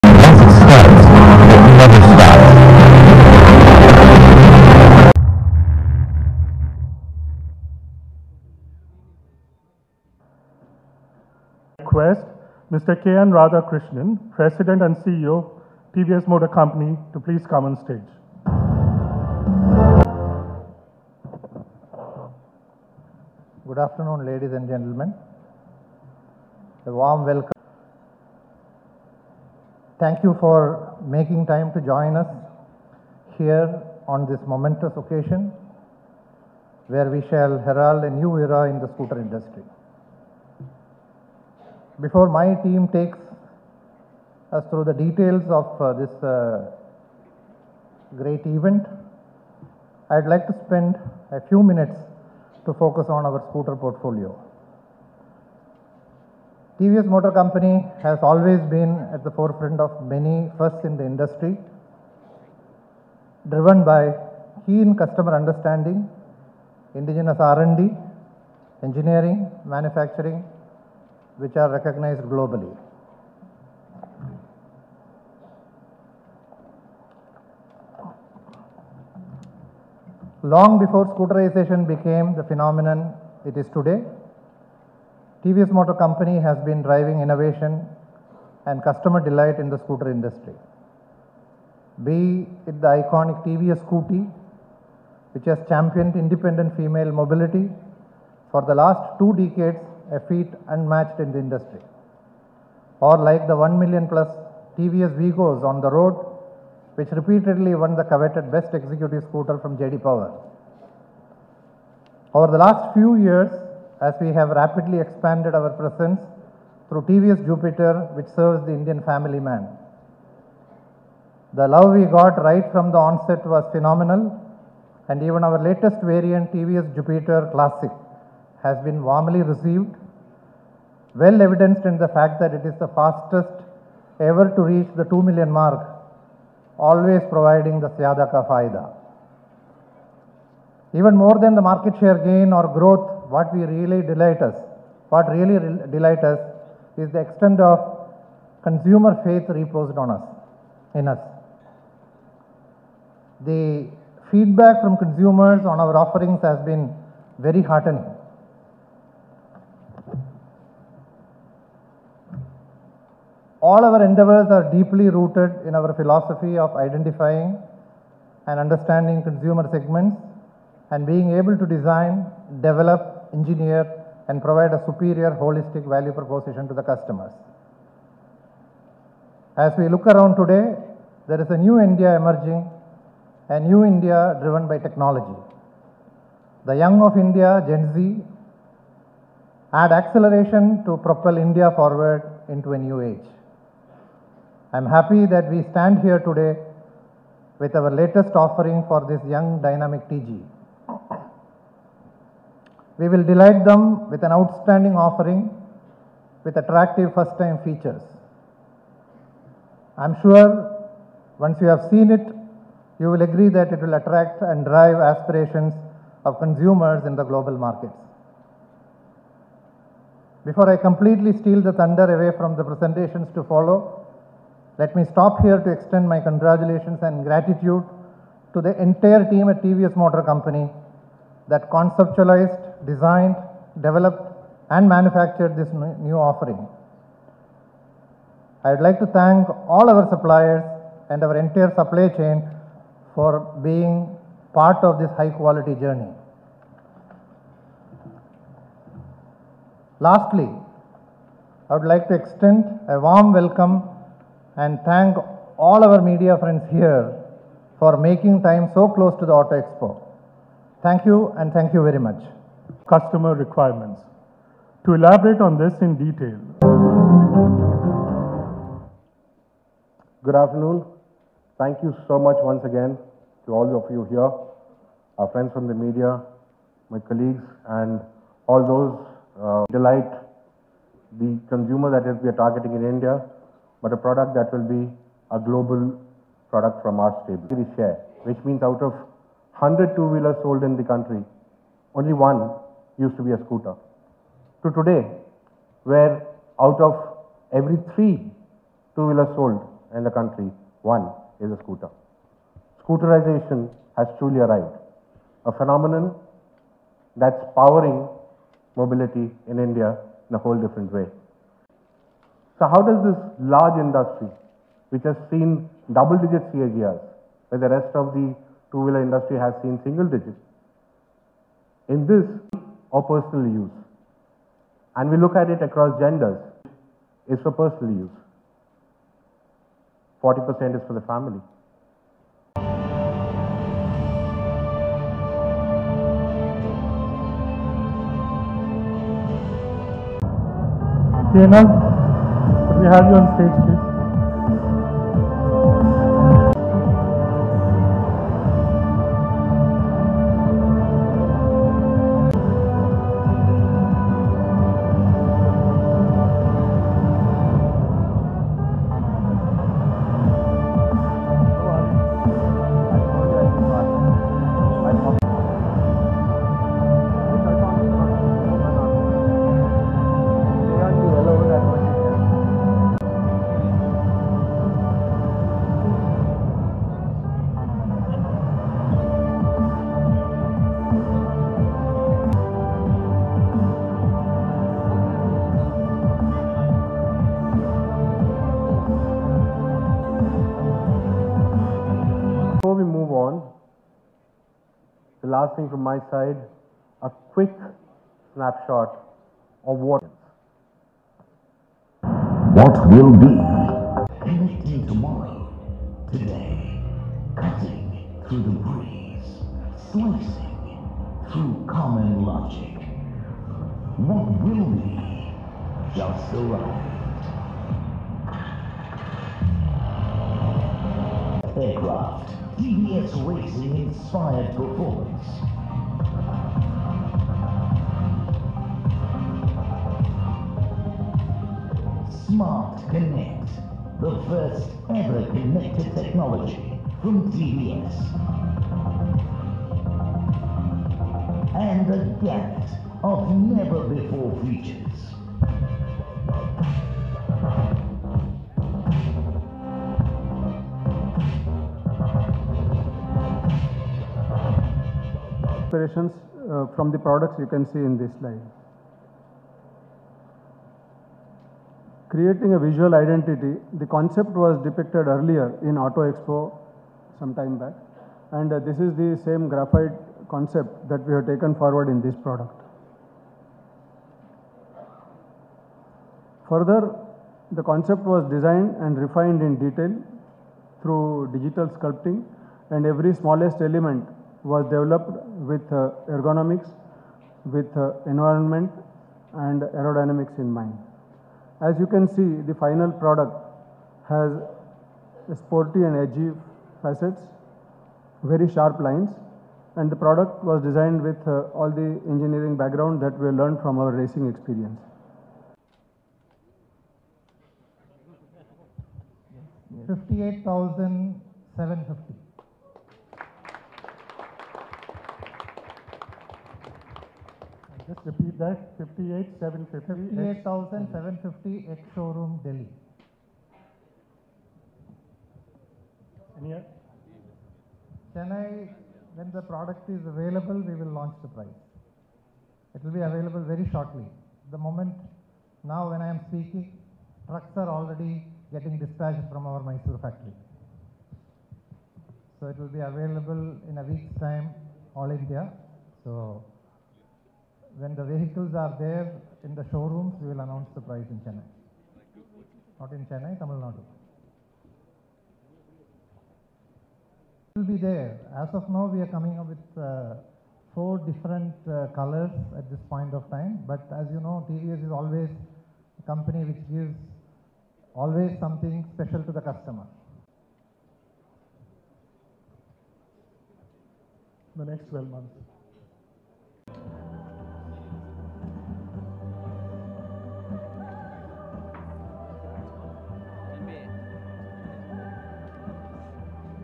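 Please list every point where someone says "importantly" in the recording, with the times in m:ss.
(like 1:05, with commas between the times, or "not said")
not said.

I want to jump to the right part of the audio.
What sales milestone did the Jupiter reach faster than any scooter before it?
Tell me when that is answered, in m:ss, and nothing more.
2:15.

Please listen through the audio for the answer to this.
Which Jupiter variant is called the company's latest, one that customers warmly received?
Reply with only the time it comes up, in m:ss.
2:06.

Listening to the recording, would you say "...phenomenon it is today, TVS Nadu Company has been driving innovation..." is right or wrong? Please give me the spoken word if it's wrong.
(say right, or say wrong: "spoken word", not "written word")
wrong: "Motor", not "Nadu".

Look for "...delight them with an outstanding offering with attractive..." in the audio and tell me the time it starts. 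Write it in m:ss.
3:23.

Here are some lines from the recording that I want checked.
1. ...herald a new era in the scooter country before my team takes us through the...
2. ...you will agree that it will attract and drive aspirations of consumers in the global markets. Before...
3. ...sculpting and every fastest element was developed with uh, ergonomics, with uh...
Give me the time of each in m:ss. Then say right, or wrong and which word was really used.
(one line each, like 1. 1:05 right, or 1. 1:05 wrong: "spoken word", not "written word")
1. 0:37 wrong: "industry", not "country"
2. 3:32 right
3. 8:01 wrong: "smallest", not "fastest".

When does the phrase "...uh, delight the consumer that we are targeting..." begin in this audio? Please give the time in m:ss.
4:39.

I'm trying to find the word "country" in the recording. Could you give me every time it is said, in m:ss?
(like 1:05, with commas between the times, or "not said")
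4:50, 5:00.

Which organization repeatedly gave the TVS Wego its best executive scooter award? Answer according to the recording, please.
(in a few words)
JD Power.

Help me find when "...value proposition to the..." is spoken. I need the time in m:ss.
2:55.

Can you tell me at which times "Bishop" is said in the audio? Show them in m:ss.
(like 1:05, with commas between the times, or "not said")
not said.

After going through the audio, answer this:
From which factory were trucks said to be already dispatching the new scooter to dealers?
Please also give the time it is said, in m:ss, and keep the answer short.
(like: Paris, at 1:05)
Mysore, at 8:59.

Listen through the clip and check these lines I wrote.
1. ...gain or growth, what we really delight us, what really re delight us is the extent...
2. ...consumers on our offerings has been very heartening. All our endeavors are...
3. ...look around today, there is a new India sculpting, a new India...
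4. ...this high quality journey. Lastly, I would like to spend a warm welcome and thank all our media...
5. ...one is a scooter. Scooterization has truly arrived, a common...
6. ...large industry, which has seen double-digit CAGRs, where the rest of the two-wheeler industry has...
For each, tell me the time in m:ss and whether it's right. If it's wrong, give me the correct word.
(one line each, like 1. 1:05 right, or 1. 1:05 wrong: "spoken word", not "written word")
1. 2:22 right
2. 2:34 right
3. 2:59 wrong: "emerging", not "sculpting"
4. 4:04 wrong: "extend", not "spend"
5. 5:00 wrong: "phenomenon", not "common"
6. 5:13 right.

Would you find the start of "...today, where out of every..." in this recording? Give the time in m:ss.
4:54.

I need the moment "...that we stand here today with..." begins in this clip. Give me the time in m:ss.
3:15.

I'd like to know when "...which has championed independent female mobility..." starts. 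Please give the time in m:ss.
1:35.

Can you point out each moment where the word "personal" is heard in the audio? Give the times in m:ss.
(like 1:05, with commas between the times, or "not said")
5:23, 5:27.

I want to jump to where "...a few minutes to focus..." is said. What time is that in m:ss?
0:51.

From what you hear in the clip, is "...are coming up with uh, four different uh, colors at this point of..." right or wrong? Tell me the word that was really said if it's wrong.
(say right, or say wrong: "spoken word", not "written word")
right.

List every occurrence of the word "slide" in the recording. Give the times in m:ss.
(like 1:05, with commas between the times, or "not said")
7:38.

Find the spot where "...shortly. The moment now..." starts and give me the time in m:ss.
8:53.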